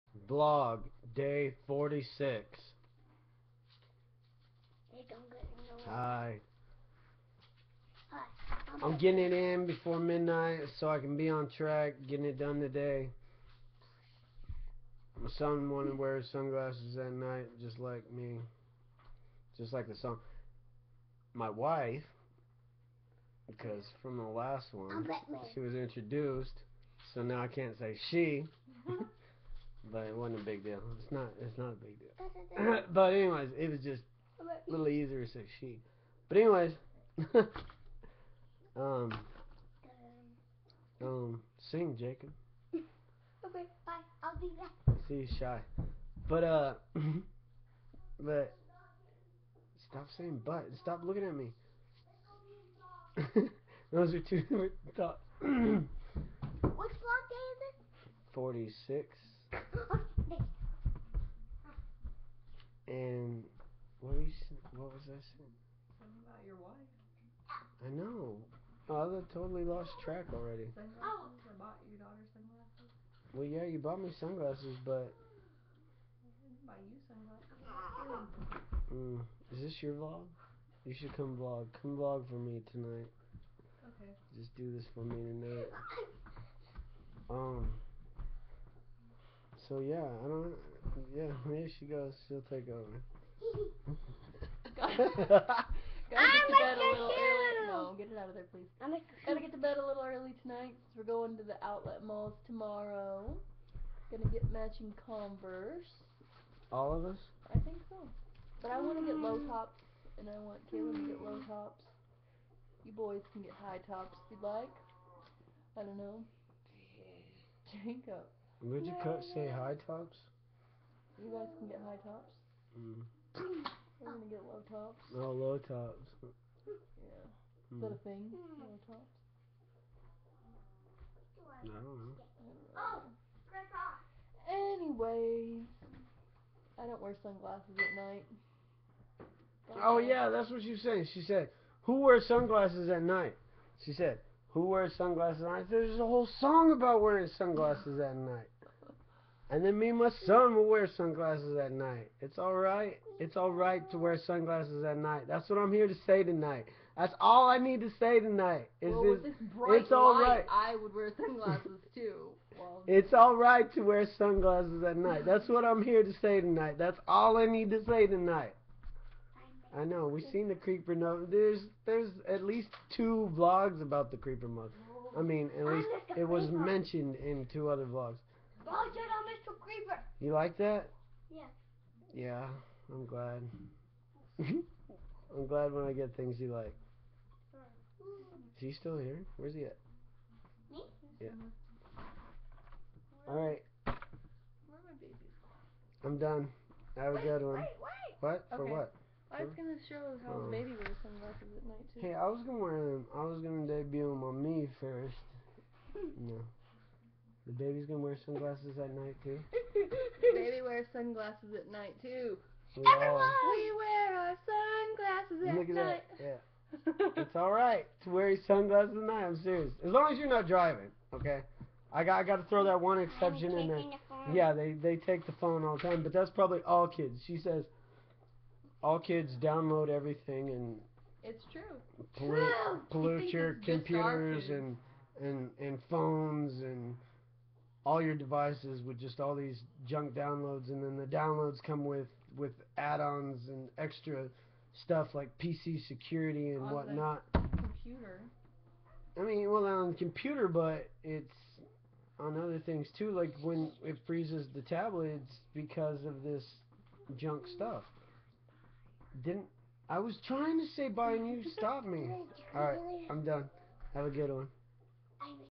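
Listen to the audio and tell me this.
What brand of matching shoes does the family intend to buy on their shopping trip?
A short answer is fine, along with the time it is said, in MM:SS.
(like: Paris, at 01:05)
Converse, at 01:45.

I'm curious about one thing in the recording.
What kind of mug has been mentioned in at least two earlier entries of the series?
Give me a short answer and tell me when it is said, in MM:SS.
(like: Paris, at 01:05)
creeper mug, at 02:54.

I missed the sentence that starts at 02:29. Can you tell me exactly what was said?
And then me and my son will wear sunglasses at night.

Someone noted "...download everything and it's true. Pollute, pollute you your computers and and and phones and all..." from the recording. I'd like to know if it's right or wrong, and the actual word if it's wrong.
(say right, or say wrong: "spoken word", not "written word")
right.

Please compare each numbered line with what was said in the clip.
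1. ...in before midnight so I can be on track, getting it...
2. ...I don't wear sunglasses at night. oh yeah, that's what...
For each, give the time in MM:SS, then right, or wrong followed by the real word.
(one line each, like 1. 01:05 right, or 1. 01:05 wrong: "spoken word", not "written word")
1. 00:09 right
2. 02:16 right.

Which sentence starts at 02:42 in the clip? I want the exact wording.
Well, it's alright to wear sunglasses at night.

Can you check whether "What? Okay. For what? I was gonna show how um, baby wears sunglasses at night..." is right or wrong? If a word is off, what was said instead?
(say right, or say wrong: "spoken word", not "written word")
right.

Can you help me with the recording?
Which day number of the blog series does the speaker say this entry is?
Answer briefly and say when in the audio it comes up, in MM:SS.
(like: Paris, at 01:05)
46, at 00:58.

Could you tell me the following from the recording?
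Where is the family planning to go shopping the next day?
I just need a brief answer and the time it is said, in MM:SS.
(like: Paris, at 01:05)
outlet malls, at 01:41.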